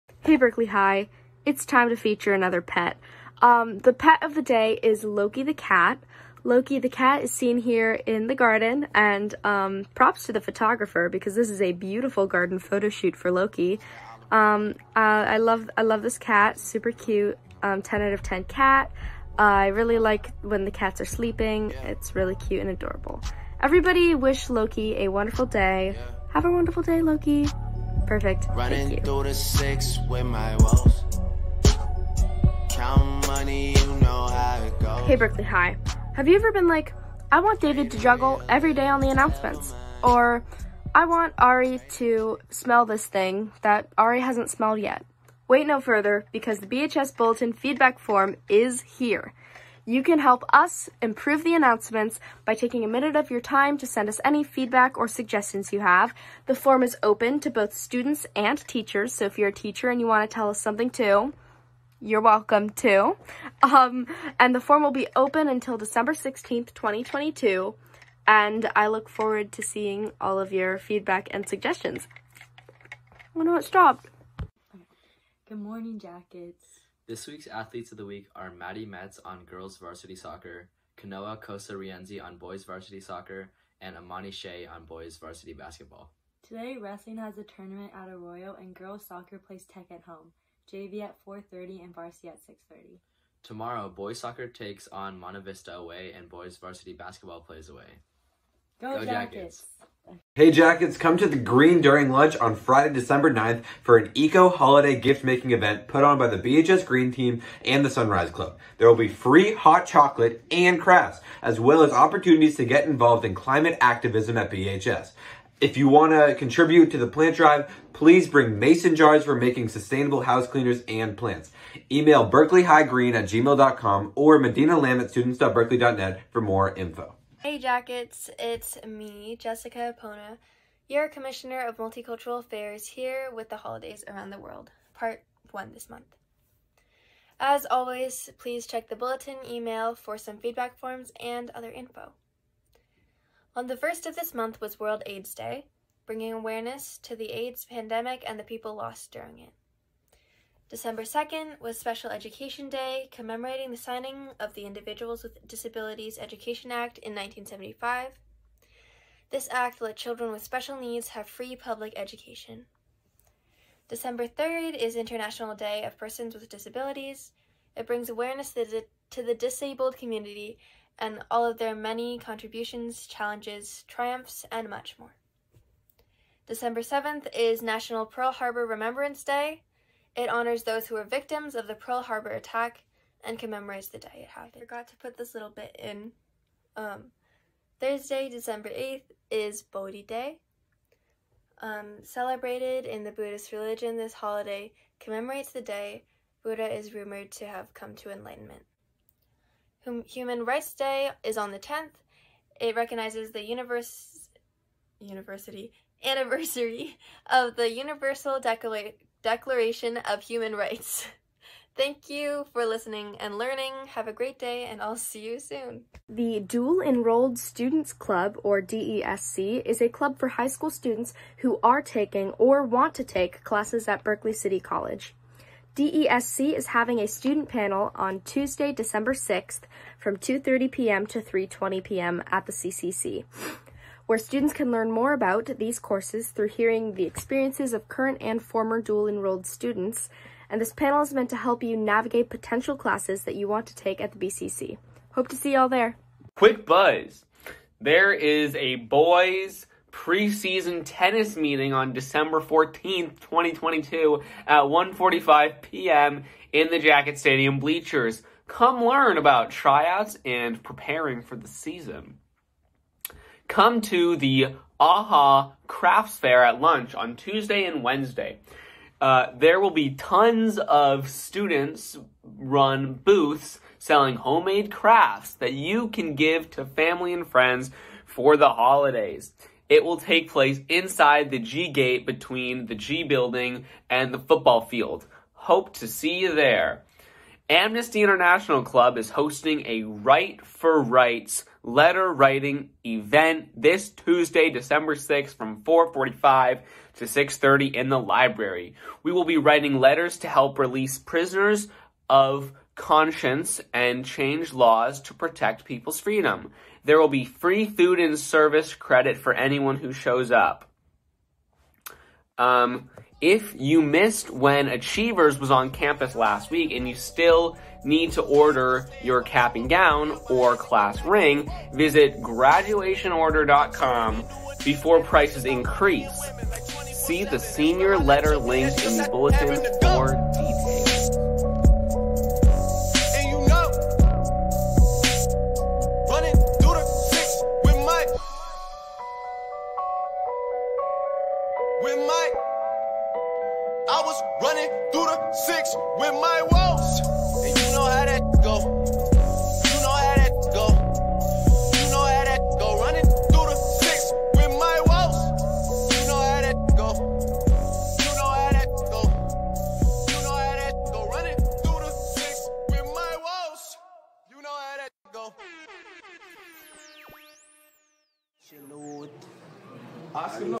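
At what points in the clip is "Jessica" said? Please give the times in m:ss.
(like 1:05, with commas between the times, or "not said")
2:09.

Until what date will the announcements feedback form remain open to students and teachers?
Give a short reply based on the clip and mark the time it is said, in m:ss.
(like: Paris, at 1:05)
December 16th, 2022, at 1:05.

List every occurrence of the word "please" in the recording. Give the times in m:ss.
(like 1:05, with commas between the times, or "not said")
1:57, 2:18.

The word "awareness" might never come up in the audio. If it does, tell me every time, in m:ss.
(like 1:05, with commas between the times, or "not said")
2:26, 2:48.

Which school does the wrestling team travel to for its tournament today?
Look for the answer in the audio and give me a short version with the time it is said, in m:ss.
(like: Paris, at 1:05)
Arroyo, at 1:28.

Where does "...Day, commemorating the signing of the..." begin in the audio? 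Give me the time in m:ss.
2:32.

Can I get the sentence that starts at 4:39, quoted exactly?
It will take place inside the G gate between the G building and the football field.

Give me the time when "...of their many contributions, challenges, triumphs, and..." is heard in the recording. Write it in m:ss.
2:51.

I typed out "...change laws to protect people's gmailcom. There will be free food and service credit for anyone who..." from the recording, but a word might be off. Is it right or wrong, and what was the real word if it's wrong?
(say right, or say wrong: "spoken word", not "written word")
wrong: "freedom", not "gmailcom".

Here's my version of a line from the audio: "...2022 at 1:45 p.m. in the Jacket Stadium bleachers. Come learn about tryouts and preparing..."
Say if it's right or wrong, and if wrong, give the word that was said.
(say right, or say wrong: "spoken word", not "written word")
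right.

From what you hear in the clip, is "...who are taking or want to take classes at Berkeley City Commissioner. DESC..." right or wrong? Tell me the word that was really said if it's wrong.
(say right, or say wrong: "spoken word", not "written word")
wrong: "College", not "Commissioner".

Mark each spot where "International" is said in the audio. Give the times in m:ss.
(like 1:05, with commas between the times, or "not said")
2:44, 4:48.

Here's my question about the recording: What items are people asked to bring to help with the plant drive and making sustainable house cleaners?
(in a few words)
mason jars.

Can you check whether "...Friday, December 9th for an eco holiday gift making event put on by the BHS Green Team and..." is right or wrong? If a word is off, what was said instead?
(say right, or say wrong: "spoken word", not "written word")
right.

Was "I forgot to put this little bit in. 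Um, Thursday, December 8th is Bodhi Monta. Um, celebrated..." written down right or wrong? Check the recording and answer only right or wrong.
wrong.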